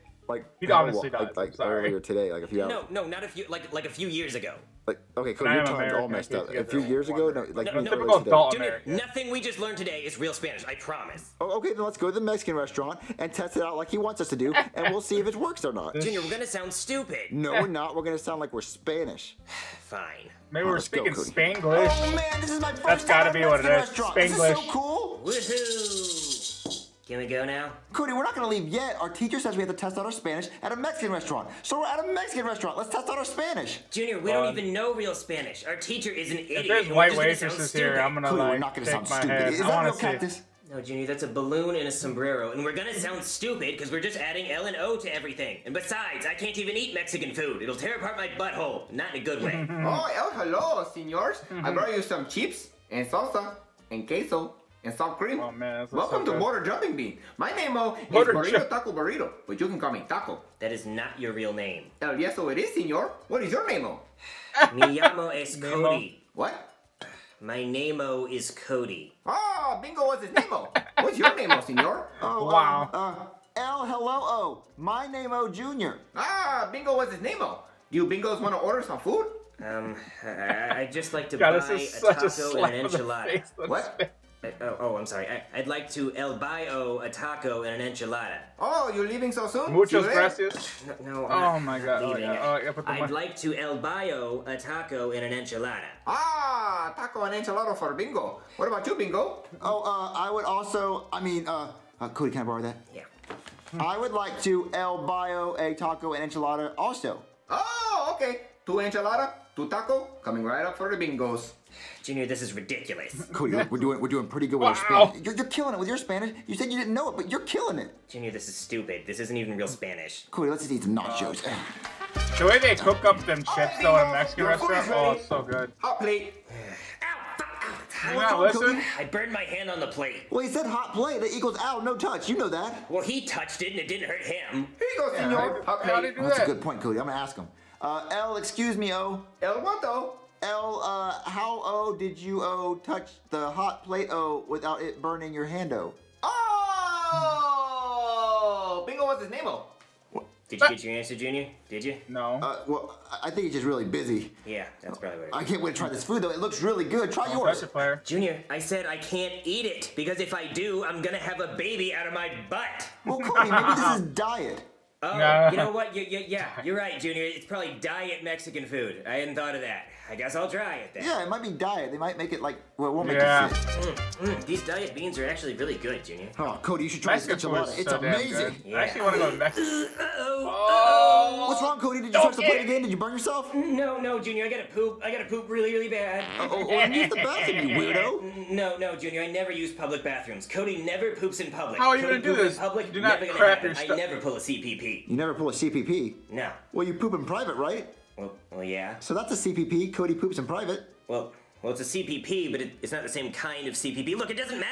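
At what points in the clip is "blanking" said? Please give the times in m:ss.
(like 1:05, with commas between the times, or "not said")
not said.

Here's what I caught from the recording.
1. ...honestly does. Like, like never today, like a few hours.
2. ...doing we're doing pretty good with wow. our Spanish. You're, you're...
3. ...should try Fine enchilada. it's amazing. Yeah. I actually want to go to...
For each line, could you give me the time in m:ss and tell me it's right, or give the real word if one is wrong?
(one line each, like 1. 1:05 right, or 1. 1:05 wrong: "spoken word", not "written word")
1. 0:00 wrong: "earlier", not "never"
2. 1:53 right
3. 2:56 wrong: "Mexican", not "Fine".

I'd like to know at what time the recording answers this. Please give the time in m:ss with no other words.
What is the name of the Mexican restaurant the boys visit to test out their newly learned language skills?
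0:56.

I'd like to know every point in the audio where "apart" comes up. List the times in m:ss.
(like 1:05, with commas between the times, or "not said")
0:47.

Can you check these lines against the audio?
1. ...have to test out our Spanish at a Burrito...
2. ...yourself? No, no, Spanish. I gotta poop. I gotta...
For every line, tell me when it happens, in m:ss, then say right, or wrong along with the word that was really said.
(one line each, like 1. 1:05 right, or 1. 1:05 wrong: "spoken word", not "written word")
1. 0:29 wrong: "Mexican", not "Burrito"
2. 3:03 wrong: "Junior", not "Spanish".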